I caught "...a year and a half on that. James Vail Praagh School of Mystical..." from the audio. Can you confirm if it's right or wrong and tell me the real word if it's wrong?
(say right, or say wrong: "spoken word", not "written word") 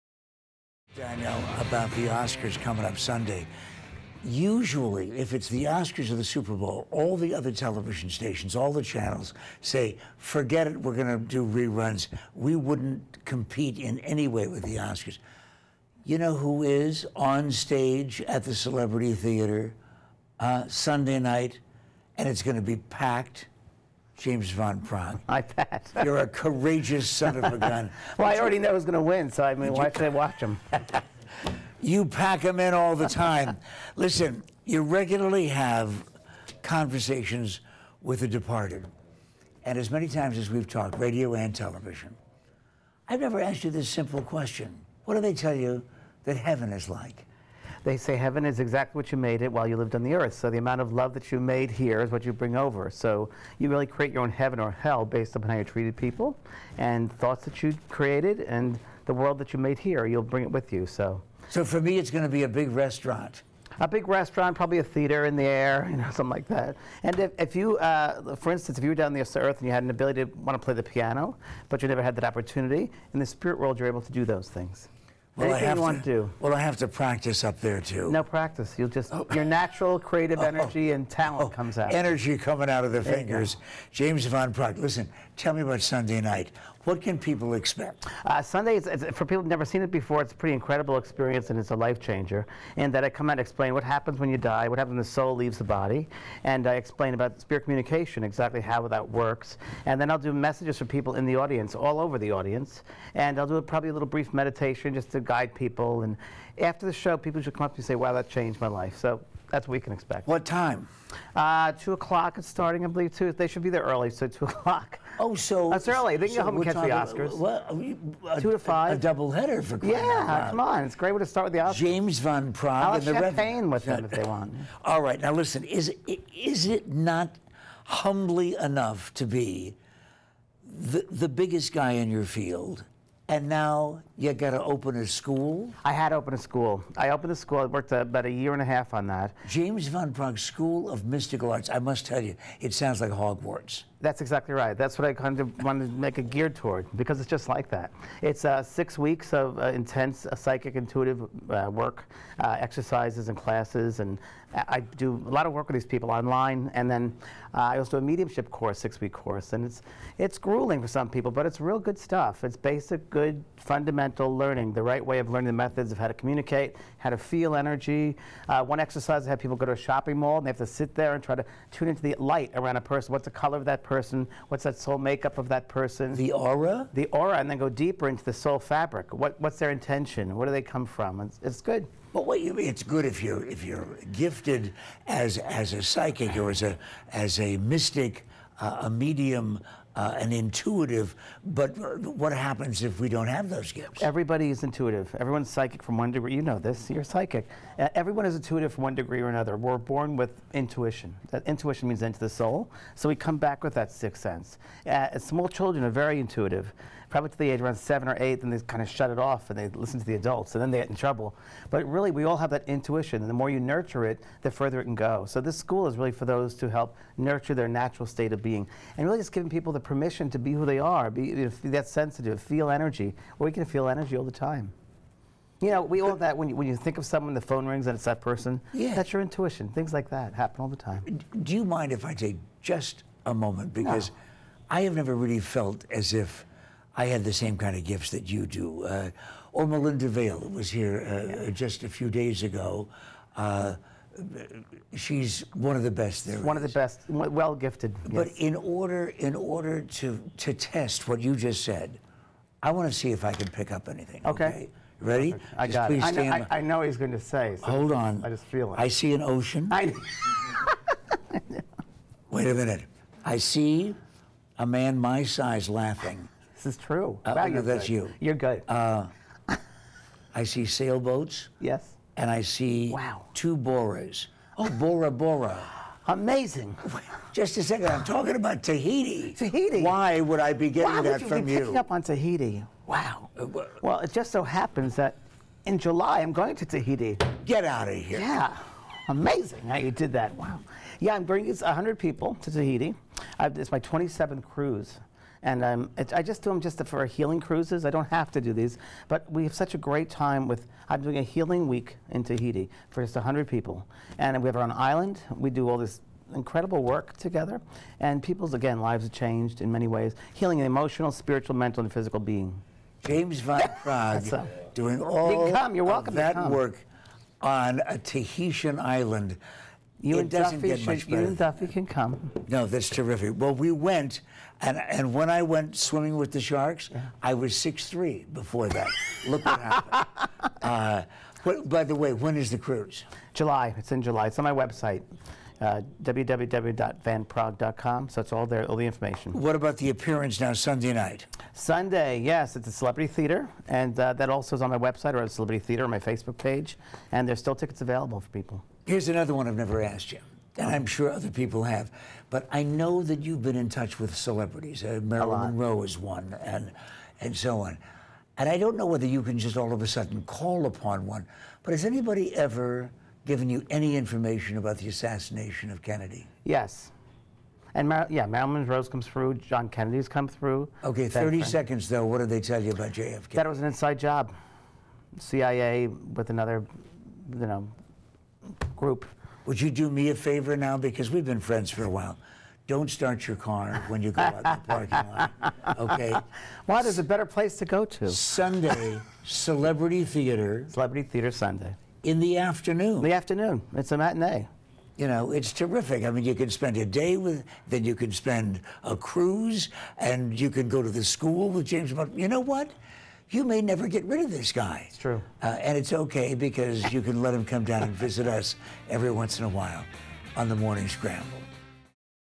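wrong: "Van", not "Vail".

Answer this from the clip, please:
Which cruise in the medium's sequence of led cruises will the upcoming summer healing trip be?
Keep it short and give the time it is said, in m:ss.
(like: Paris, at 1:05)
27th, at 4:53.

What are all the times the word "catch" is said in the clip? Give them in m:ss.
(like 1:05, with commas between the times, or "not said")
1:56.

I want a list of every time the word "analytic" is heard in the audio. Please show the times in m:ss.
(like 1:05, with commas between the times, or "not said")
not said.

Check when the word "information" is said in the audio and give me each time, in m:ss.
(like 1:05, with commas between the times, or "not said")
5:38, 6:03.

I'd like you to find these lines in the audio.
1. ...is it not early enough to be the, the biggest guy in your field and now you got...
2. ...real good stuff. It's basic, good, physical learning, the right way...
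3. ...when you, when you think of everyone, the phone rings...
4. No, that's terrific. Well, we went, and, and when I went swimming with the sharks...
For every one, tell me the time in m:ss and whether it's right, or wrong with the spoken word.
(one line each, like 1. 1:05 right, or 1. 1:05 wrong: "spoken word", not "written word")
1. 2:06 wrong: "humbly", not "early"
2. 2:41 wrong: "fundamental", not "physical"
3. 3:46 wrong: "someone", not "everyone"
4. 5:22 right.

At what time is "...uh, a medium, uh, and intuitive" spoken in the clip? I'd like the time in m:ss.
3:08.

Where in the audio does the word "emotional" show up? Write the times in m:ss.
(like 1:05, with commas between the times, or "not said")
5:10.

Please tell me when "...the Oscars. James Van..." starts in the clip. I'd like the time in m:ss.
2:01.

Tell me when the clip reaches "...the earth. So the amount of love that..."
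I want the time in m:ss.
0:50.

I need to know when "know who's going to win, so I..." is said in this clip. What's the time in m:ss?
0:28.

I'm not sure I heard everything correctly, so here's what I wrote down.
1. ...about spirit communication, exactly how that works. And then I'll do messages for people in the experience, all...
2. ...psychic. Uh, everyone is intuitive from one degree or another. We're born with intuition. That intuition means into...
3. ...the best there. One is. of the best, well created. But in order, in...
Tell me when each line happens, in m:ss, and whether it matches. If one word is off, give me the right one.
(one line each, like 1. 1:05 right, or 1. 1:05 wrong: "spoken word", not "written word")
1. 1:37 wrong: "audience", not "experience"
2. 3:17 right
3. 4:05 wrong: "gifted", not "created".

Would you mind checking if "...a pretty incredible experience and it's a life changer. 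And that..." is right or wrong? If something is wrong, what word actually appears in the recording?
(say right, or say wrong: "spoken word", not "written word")
right.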